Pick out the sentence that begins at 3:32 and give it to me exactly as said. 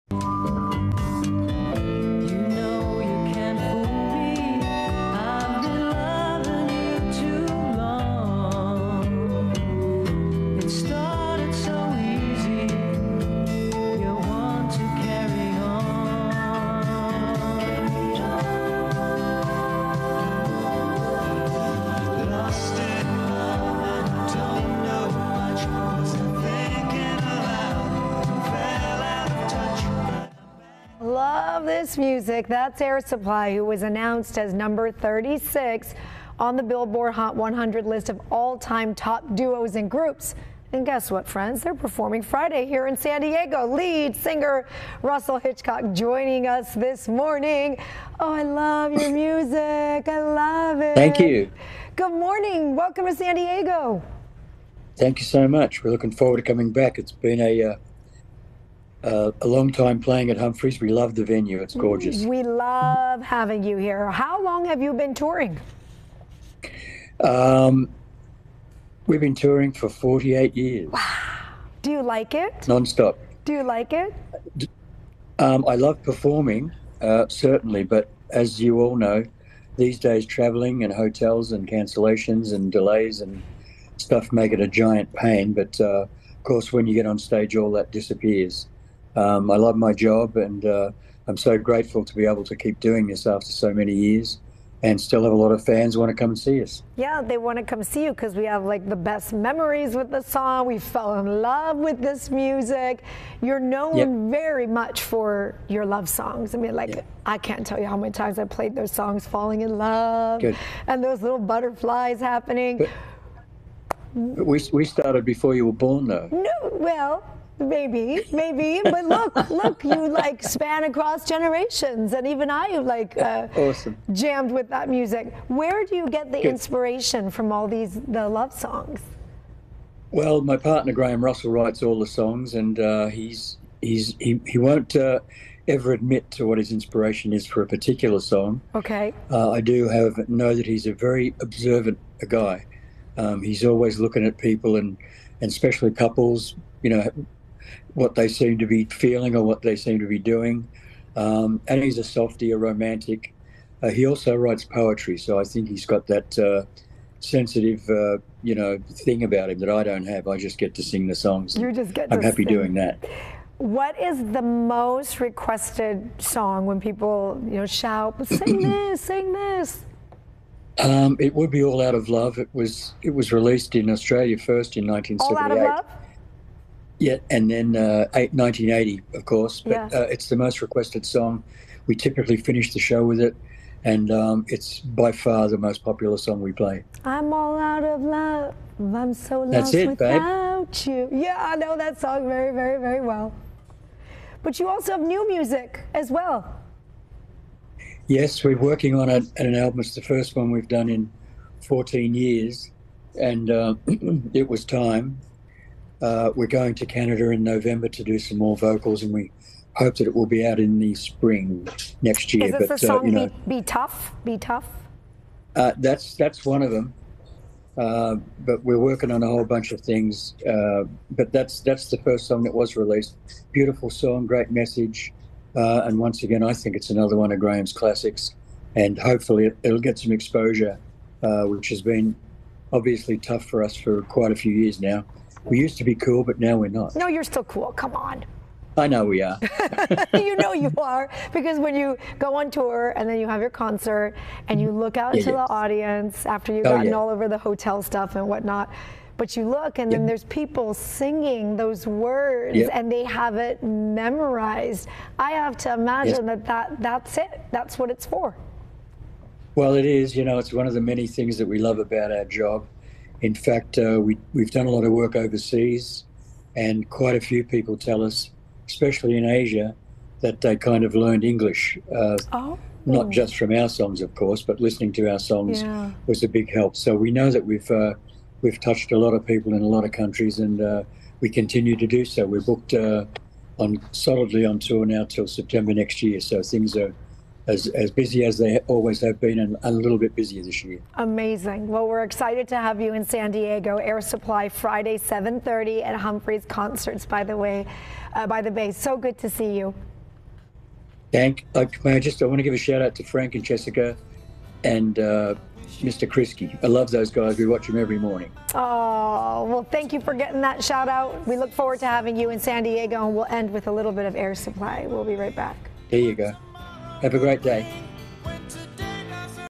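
Is but, the uh, song uh, you know, be, be, Tough?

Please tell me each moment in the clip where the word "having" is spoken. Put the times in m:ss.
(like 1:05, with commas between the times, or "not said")
1:03, 5:11.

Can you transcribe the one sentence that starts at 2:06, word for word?
inspiration from all these the love songs?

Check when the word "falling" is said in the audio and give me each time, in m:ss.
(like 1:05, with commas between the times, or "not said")
1:49.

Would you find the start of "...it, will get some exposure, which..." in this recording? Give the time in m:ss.
3:49.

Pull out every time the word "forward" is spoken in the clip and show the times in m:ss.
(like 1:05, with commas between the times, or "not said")
0:56, 5:11.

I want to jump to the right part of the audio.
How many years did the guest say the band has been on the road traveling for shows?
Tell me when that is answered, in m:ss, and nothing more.
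1:09.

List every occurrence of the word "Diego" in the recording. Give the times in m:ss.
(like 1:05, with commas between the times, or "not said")
0:43, 0:53, 4:53, 5:12.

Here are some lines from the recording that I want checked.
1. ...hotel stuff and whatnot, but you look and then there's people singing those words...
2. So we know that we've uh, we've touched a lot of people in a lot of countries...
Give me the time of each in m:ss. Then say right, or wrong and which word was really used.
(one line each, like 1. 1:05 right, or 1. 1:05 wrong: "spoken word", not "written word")
1. 4:07 right
2. 4:36 right.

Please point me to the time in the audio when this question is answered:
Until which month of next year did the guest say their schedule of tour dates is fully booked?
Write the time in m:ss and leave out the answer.
4:45.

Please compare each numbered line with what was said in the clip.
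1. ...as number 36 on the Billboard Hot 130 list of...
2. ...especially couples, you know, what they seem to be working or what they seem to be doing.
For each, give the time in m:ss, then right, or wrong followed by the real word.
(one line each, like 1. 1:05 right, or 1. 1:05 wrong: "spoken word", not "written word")
1. 0:34 wrong: "100", not "130"
2. 2:25 wrong: "feeling", not "working".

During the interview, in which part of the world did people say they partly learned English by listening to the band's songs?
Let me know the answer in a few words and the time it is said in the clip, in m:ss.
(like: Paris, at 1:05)
Asia, at 4:29.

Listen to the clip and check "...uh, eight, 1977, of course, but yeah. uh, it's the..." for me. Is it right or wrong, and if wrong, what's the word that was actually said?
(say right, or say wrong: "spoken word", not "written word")
wrong: "1980", not "1977".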